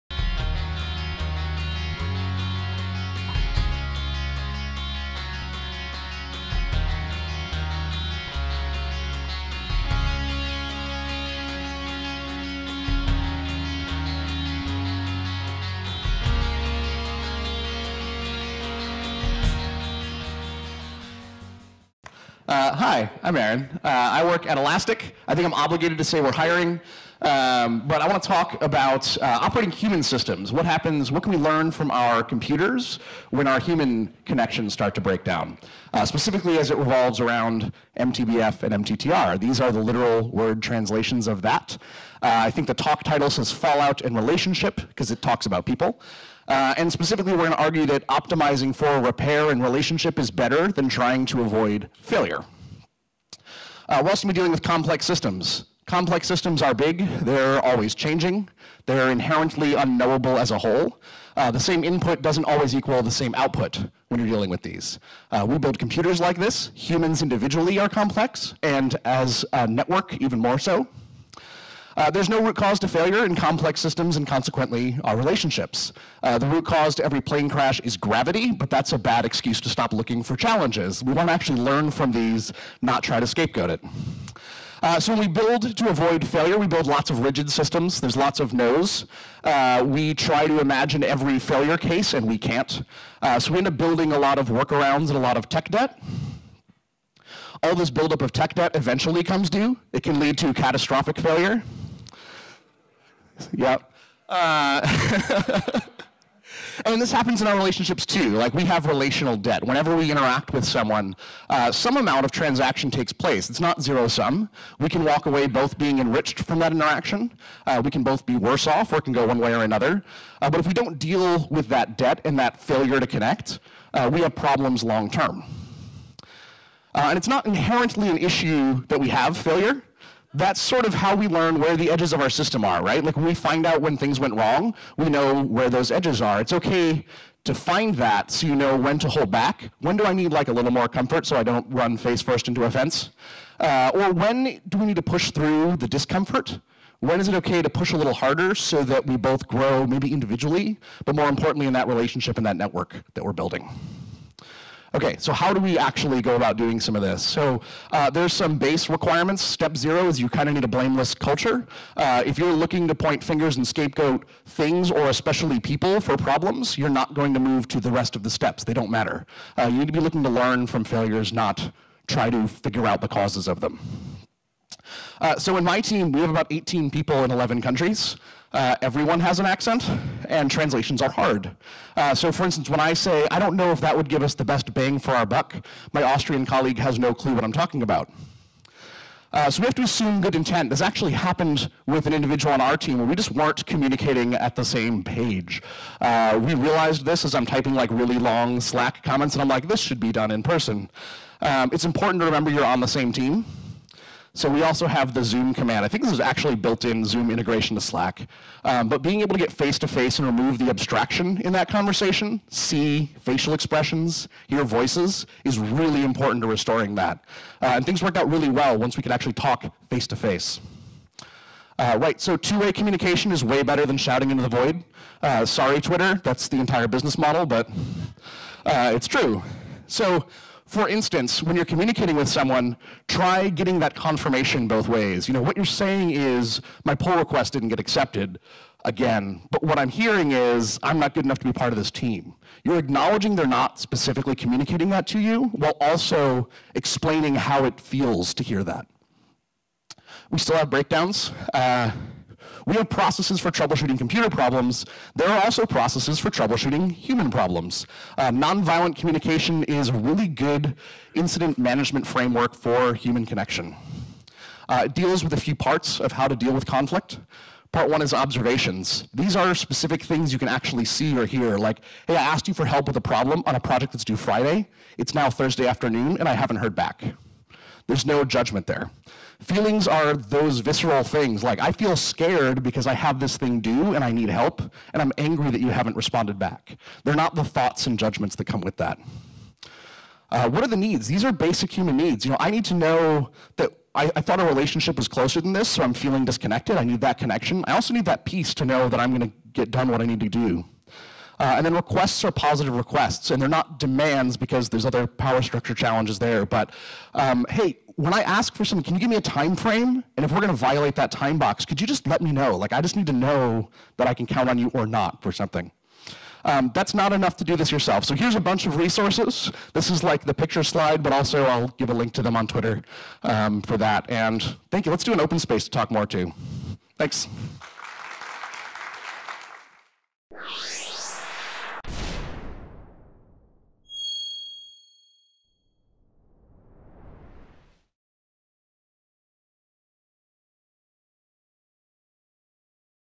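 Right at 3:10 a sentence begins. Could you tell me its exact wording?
This actually happened with an individual on our team where we just weren't communicating at the same page.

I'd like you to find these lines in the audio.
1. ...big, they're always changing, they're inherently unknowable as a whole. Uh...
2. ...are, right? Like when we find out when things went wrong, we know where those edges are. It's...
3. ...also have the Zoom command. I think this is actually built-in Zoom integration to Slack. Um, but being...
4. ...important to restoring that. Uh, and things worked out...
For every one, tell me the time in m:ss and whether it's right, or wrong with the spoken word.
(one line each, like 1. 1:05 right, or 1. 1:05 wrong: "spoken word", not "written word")
1. 0:56 right
2. 2:12 right
3. 3:24 right
4. 3:36 right.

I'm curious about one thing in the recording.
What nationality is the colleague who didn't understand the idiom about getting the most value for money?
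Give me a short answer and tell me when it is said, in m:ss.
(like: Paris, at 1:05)
Austrian, at 3:06.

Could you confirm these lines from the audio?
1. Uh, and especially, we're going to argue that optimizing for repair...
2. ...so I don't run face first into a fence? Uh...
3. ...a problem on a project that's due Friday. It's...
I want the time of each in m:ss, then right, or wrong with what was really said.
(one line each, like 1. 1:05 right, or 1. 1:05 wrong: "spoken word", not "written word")
1. 0:46 wrong: "specifically", not "especially"
2. 2:21 right
3. 4:32 right.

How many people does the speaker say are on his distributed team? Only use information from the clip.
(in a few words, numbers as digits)
18.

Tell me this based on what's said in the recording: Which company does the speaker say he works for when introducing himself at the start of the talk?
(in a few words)
Elastic.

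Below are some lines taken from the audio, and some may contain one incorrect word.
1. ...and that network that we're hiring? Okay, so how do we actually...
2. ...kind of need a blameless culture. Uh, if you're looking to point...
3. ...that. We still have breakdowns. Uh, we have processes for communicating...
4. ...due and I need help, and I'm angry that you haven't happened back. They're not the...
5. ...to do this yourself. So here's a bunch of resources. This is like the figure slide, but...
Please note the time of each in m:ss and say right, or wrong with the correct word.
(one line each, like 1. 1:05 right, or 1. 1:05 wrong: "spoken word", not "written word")
1. 2:32 wrong: "building", not "hiring"
2. 2:40 right
3. 4:08 wrong: "troubleshooting", not "communicating"
4. 4:43 wrong: "responded", not "happened"
5. 5:17 wrong: "picture", not "figure".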